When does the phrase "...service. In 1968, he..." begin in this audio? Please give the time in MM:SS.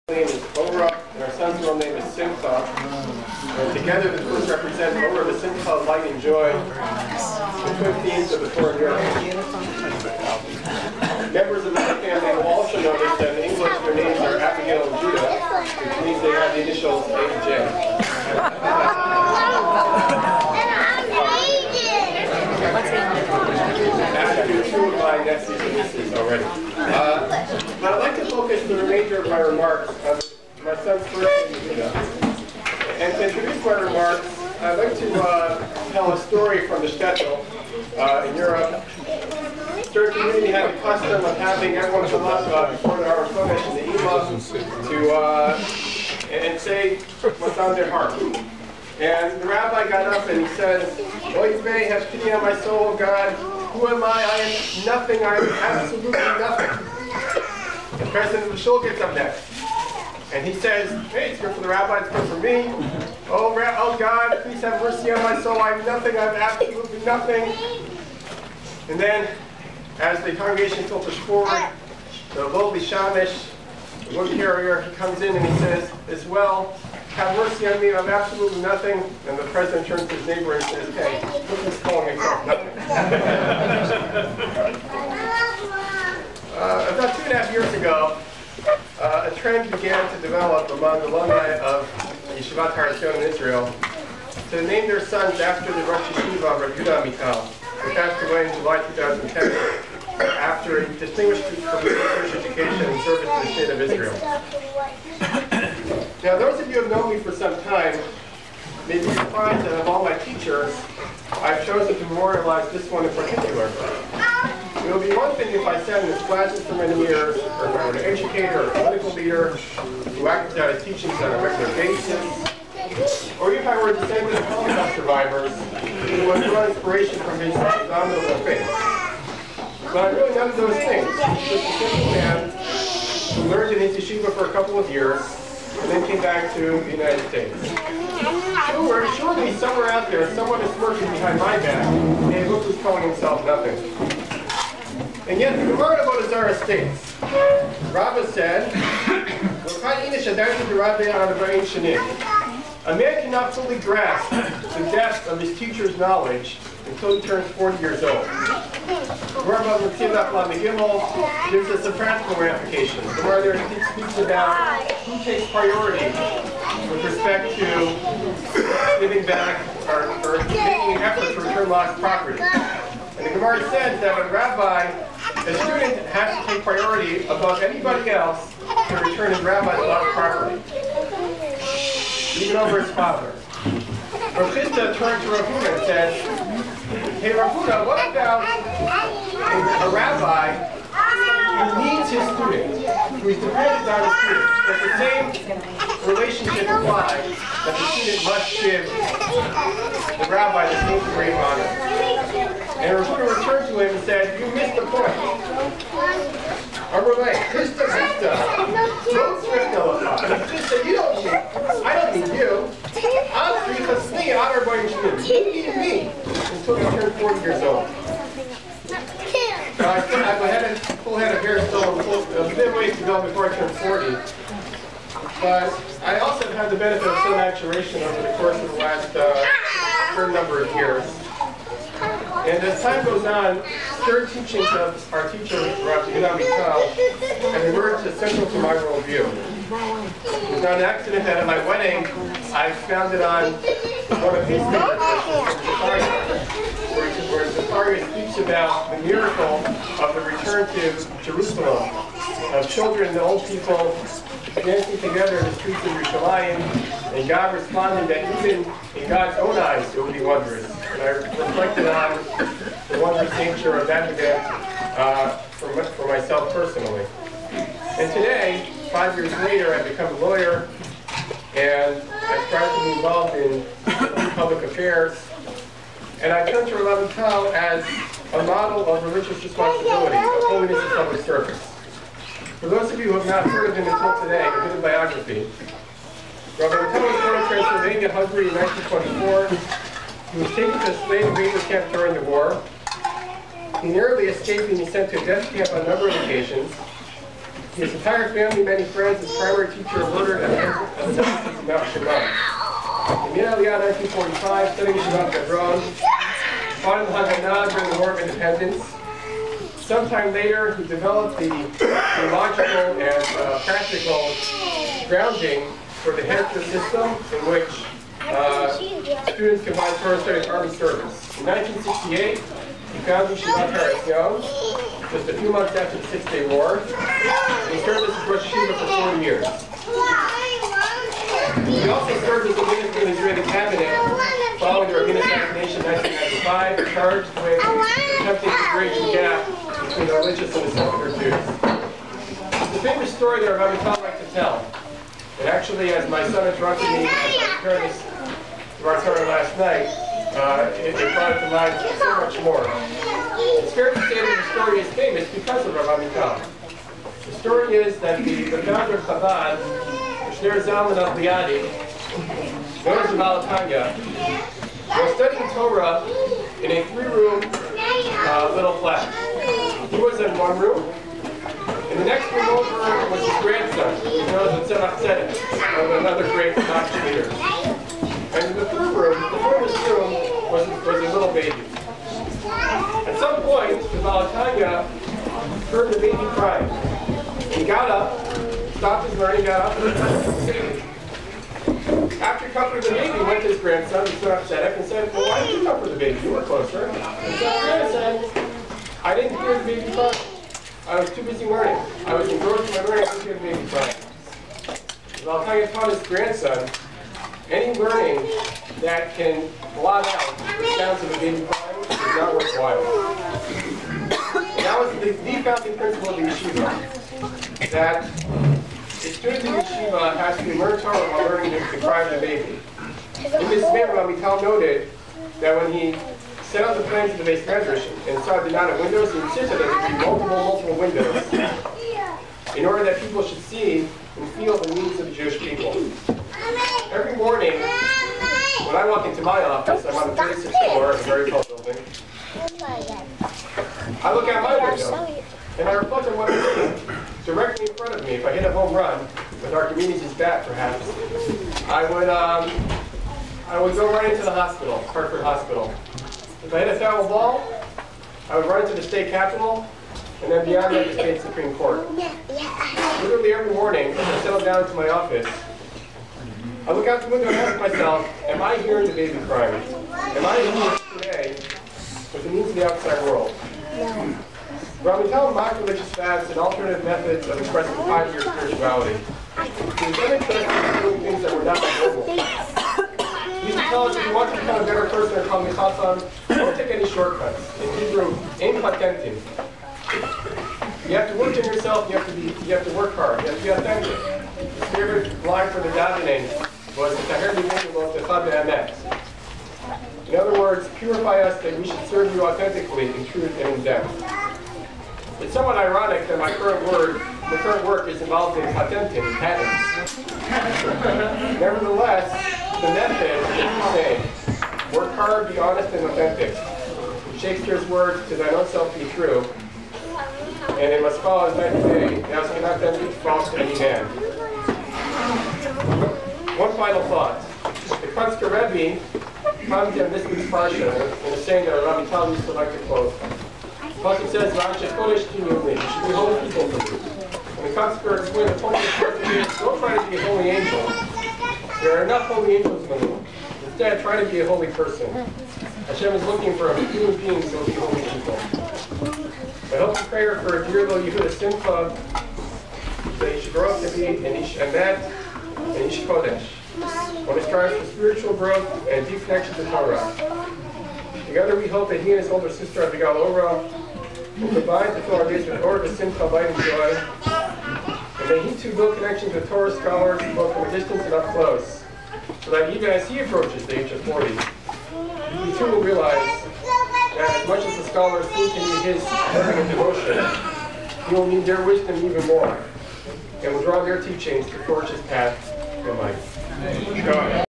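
05:20.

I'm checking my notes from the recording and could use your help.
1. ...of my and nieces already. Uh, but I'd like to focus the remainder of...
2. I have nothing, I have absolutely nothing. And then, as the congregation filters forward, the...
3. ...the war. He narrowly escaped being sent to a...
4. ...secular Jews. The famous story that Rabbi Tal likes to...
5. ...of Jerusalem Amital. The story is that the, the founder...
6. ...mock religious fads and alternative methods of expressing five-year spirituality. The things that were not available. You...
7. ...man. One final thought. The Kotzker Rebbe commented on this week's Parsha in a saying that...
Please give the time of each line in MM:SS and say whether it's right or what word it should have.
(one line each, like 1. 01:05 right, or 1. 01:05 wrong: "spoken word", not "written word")
1. 00:24 right
2. 01:05 right
3. 04:52 right
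4. 05:40 right
5. 05:55 wrong: "Rabbi", not "Jerusalem"
6. 07:55 right
7. 08:43 right.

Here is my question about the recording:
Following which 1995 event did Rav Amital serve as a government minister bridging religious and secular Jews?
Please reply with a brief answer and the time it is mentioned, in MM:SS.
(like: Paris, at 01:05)
Rabin assassination, at 05:34.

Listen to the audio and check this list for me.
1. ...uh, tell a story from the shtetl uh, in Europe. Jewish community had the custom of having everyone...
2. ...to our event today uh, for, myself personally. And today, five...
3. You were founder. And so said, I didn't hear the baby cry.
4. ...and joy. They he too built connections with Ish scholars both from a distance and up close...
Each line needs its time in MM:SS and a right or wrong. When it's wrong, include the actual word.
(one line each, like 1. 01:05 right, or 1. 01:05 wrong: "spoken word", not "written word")
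1. 00:35 right
2. 04:23 right
3. 06:36 wrong: "closer", not "founder"
4. 09:26 wrong: "Torah", not "Ish".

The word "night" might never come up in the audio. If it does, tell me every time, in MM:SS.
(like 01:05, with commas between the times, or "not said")
05:49, 08:41.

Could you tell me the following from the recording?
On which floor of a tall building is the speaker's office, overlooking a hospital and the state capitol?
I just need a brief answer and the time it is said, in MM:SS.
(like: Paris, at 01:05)
36th, at 07:20.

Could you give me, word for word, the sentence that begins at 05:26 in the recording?
He served as Rosh Yeshiva for four years.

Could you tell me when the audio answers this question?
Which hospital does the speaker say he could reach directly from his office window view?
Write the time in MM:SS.
07:34.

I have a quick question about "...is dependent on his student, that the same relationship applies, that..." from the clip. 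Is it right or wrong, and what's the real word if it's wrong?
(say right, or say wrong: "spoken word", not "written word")
right.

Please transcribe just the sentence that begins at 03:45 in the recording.
But I also have had the benefit of some maturation over the course of the last uh, certain number of years.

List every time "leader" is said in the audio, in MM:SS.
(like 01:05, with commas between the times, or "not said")
01:59, 06:17.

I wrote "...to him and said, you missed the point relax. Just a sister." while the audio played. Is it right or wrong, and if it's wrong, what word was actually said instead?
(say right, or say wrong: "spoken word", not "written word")
right.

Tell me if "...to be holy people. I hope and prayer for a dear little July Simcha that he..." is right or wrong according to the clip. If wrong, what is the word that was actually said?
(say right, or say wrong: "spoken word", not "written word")
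wrong: "Yehuda", not "July".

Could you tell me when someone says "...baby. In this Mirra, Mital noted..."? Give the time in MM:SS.
07:02.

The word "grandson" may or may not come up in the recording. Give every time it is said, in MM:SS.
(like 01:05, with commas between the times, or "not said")
06:13, 06:33, 06:46.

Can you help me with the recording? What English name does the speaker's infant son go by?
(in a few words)
Judah.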